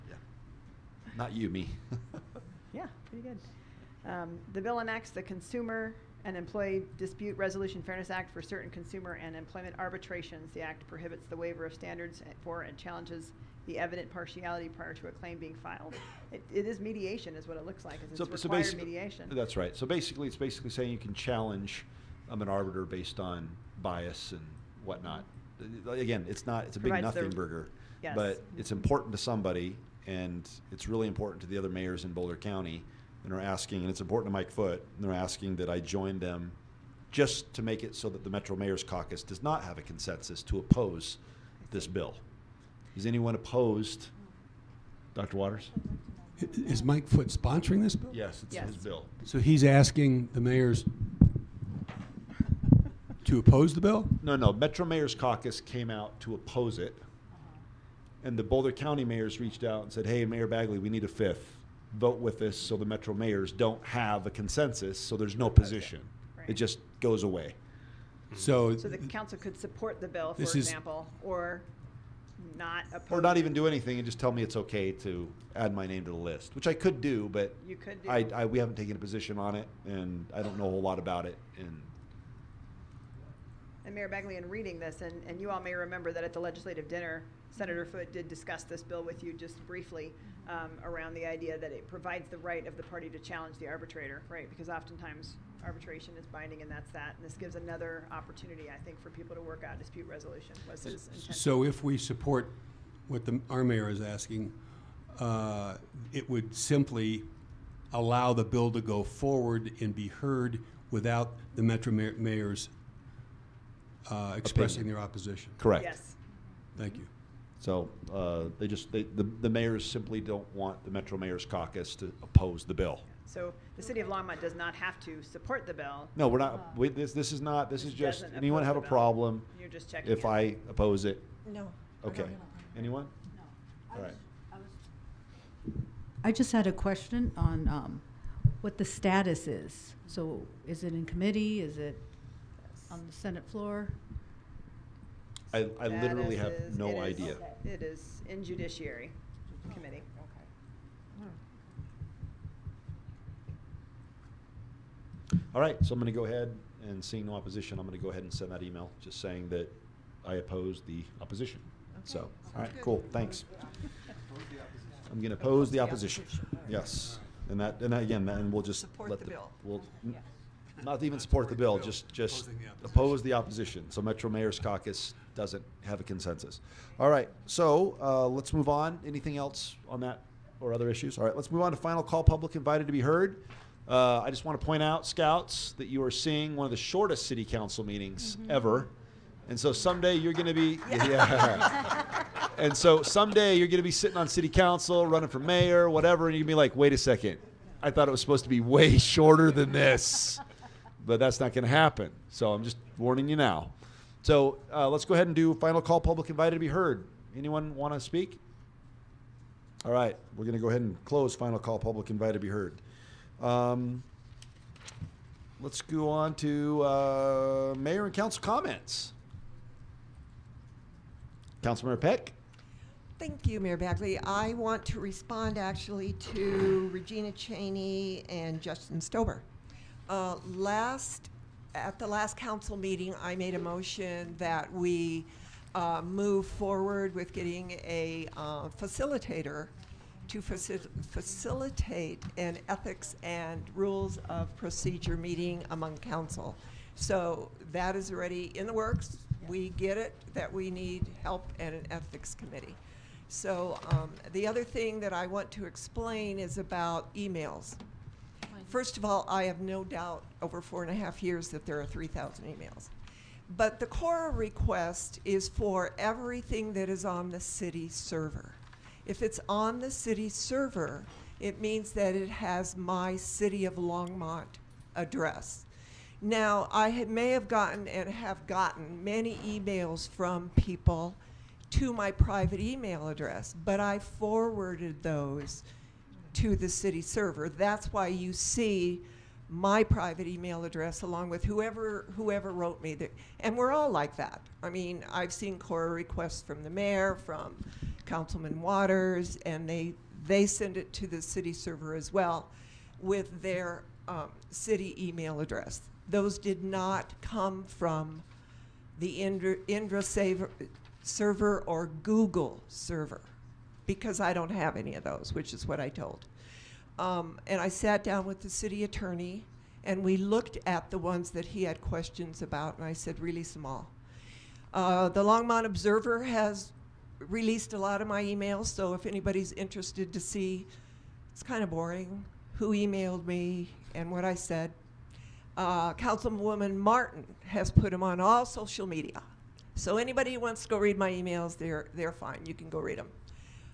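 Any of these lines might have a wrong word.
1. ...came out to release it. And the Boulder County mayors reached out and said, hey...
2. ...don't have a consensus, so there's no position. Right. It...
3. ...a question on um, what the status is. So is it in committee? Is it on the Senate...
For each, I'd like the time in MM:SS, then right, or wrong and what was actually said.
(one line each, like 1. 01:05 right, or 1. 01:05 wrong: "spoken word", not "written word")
1. 00:55 wrong: "oppose", not "release"
2. 01:03 right
3. 02:16 right.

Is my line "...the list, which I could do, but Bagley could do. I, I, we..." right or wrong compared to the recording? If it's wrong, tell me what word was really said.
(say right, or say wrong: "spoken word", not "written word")
wrong: "You", not "Bagley".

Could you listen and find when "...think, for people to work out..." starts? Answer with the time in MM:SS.
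01:38.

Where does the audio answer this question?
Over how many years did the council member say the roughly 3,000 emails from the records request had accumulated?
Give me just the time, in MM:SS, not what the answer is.
04:20.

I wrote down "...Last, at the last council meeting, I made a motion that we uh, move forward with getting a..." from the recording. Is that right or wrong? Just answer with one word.
right.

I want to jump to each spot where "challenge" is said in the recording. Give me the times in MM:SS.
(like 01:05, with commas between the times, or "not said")
00:12, 00:21, 01:33.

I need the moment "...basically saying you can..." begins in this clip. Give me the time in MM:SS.
00:20.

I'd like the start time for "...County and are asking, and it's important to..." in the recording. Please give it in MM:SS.
00:32.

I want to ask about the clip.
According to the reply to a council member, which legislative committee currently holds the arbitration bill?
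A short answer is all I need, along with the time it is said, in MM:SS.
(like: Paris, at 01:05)
Judiciary committee, at 02:28.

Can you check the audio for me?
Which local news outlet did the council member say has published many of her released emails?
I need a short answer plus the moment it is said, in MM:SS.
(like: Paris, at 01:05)
Longmont Observer, at 05:25.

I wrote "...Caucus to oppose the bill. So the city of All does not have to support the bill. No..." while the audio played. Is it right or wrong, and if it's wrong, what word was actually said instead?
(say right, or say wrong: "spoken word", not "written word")
wrong: "Longmont", not "All".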